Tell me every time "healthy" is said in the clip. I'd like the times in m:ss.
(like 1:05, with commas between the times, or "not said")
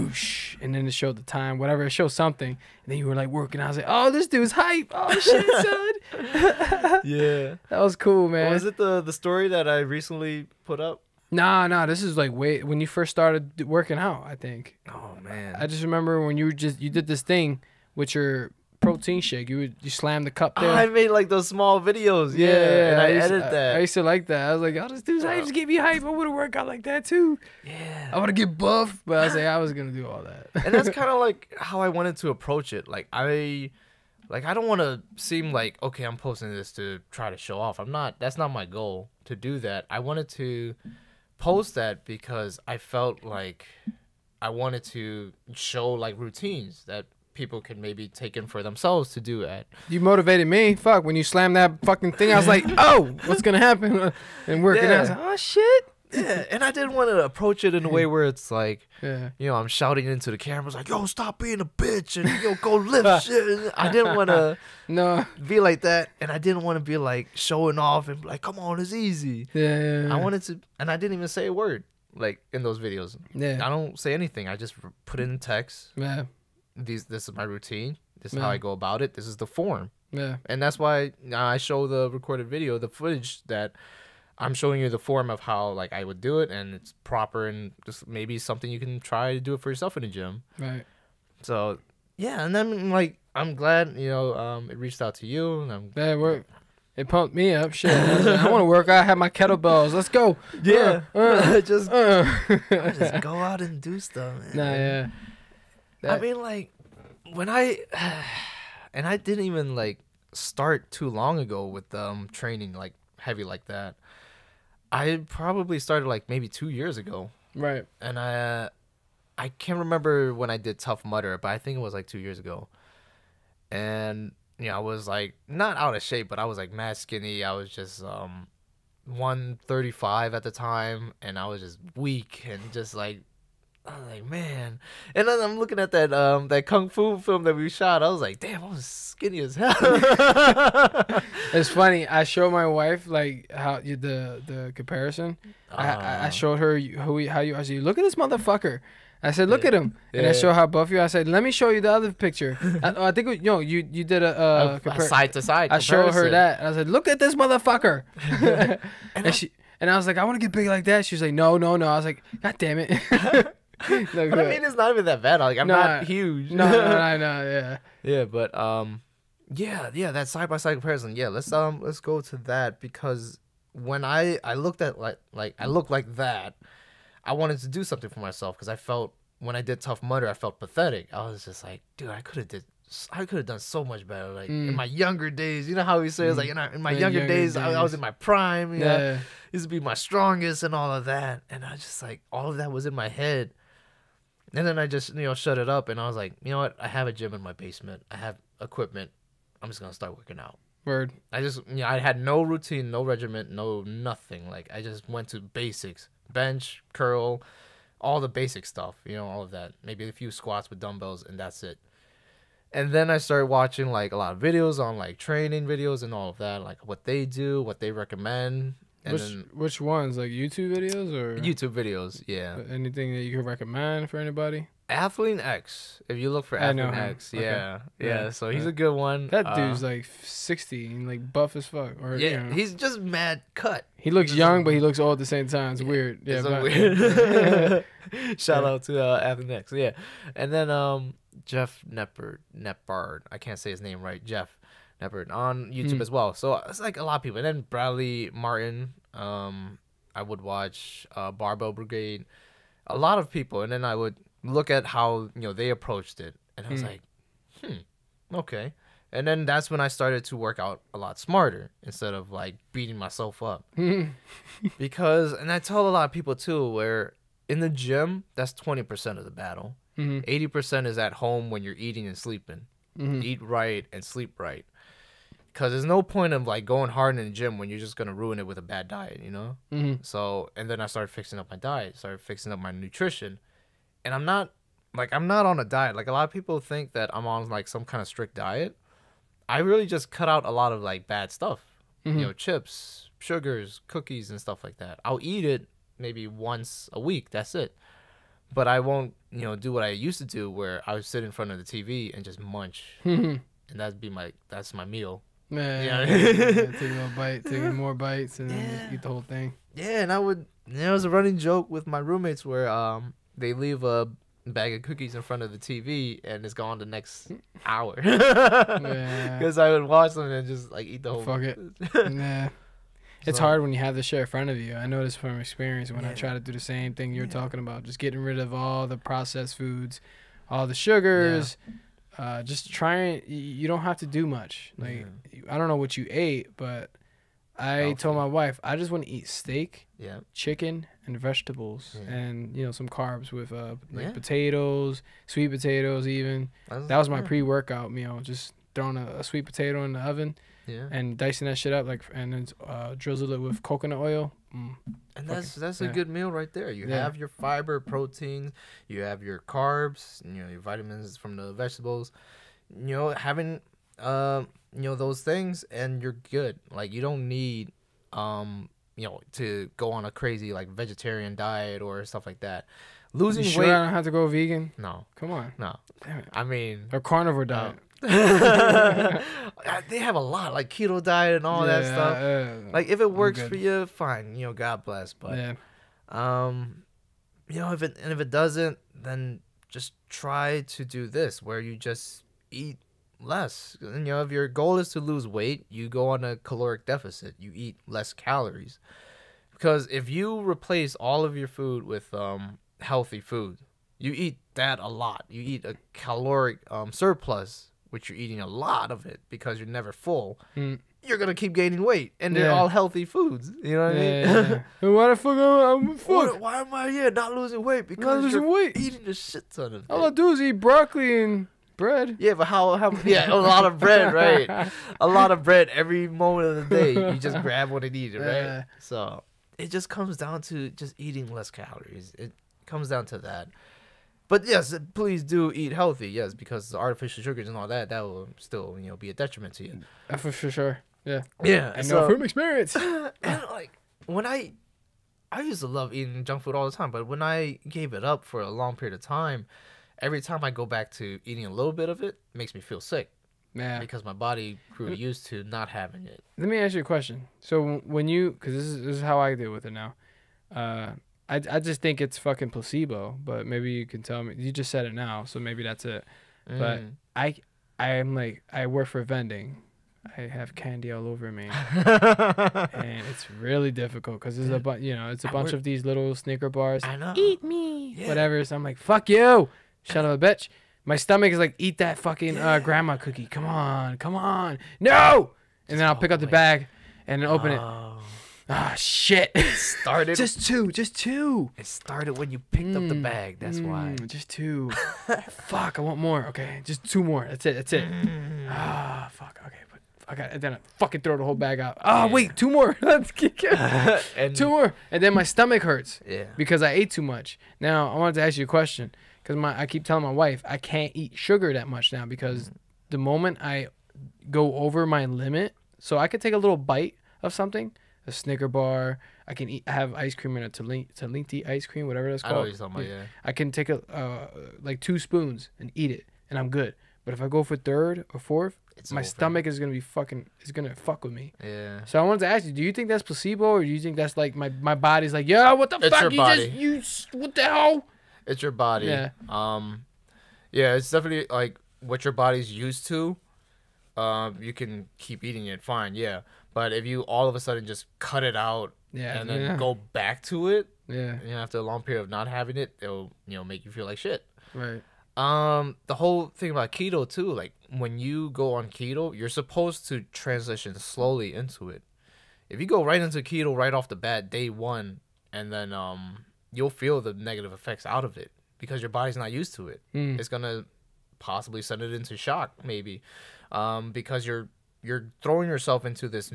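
5:37, 6:42, 6:52, 7:15.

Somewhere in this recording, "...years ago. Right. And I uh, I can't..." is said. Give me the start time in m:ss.
1:56.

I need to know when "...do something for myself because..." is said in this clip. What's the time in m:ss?
2:57.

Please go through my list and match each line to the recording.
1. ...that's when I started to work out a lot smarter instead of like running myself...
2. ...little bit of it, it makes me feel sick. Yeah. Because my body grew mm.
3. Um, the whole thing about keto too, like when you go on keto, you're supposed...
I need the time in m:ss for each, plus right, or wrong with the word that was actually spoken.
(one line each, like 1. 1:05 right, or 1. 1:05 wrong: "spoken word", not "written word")
1. 4:19 wrong: "beating", not "running"
2. 7:31 right
3. 9:15 right.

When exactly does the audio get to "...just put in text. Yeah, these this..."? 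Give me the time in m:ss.
1:14.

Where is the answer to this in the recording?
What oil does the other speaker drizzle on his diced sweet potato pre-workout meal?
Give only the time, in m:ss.
5:53.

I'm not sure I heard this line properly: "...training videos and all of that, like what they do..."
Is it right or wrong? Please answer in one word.
right.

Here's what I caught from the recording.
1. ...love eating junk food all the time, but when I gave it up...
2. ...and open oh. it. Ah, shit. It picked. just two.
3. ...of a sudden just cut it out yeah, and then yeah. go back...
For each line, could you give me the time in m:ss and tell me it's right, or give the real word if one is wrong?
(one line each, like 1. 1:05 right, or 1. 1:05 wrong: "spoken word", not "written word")
1. 7:25 right
2. 8:07 wrong: "started", not "picked"
3. 9:07 right.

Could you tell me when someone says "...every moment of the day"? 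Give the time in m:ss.
7:05.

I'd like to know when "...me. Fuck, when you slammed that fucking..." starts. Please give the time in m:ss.
0:50.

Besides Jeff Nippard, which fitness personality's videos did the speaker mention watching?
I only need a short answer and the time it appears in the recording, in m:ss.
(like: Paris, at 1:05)
Bradley Martyn, at 4:07.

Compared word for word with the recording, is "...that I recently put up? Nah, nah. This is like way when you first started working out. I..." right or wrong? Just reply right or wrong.
right.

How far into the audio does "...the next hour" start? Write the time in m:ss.
5:16.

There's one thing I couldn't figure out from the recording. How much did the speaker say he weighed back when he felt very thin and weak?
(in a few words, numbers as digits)
135.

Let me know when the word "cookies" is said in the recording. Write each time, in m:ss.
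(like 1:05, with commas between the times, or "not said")
4:53, 5:14, 8:02.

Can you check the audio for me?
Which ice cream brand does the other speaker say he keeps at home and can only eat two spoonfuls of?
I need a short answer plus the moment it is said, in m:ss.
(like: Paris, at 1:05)
Talenti, at 8:40.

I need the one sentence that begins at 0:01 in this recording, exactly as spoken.
It showed something, and then you were like working.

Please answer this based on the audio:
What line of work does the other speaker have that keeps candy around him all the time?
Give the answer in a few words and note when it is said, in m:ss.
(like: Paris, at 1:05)
vending, at 7:49.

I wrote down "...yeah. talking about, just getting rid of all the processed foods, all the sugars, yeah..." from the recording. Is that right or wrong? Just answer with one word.
right.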